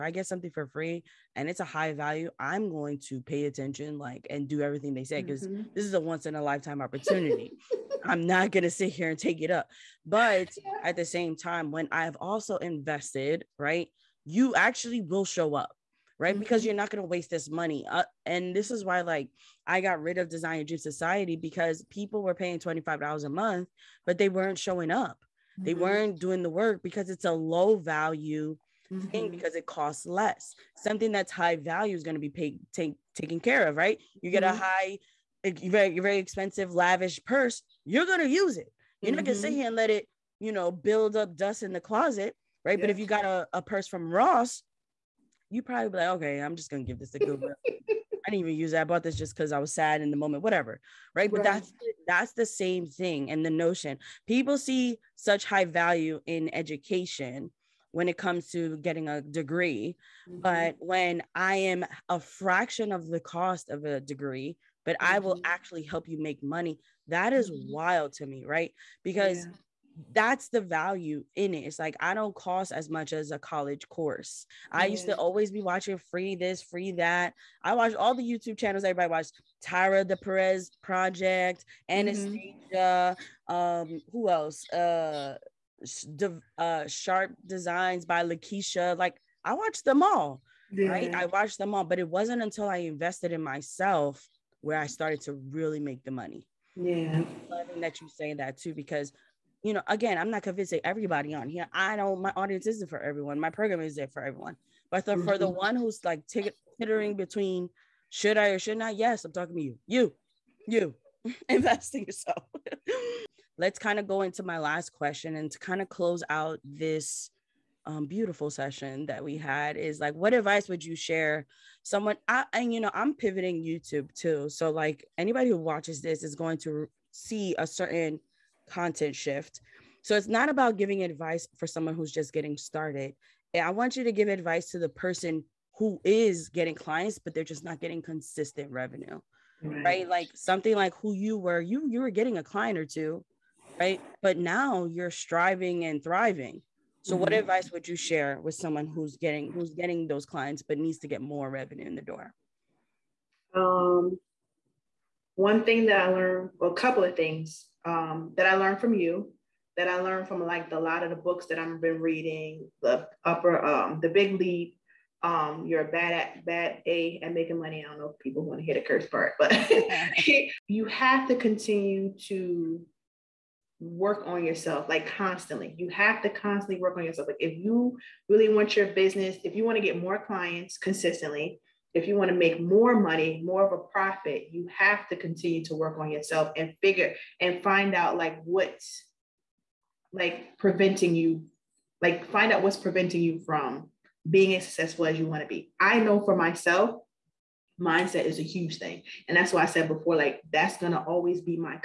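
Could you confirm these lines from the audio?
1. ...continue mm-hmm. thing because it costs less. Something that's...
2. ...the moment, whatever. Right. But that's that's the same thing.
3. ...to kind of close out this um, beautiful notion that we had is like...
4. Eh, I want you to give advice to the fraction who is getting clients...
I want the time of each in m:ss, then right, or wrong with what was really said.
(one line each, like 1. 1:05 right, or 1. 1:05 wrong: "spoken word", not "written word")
1. 0:27 wrong: "value", not "continue"
2. 0:50 right
3. 1:55 wrong: "session", not "notion"
4. 2:13 wrong: "person", not "fraction".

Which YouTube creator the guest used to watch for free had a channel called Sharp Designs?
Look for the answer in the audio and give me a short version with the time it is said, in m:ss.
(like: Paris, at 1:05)
Lakeisha, at 1:28.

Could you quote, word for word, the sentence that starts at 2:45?
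Um, you're a bad at bad a at making money.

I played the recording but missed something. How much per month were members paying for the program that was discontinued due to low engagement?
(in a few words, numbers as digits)
$25.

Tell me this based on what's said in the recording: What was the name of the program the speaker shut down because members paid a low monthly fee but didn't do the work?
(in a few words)
Design and Dream Society.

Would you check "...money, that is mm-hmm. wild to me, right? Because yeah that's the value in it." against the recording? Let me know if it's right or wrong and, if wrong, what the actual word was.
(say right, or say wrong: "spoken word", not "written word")
right.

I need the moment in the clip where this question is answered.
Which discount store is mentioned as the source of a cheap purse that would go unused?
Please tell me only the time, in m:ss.
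0:44.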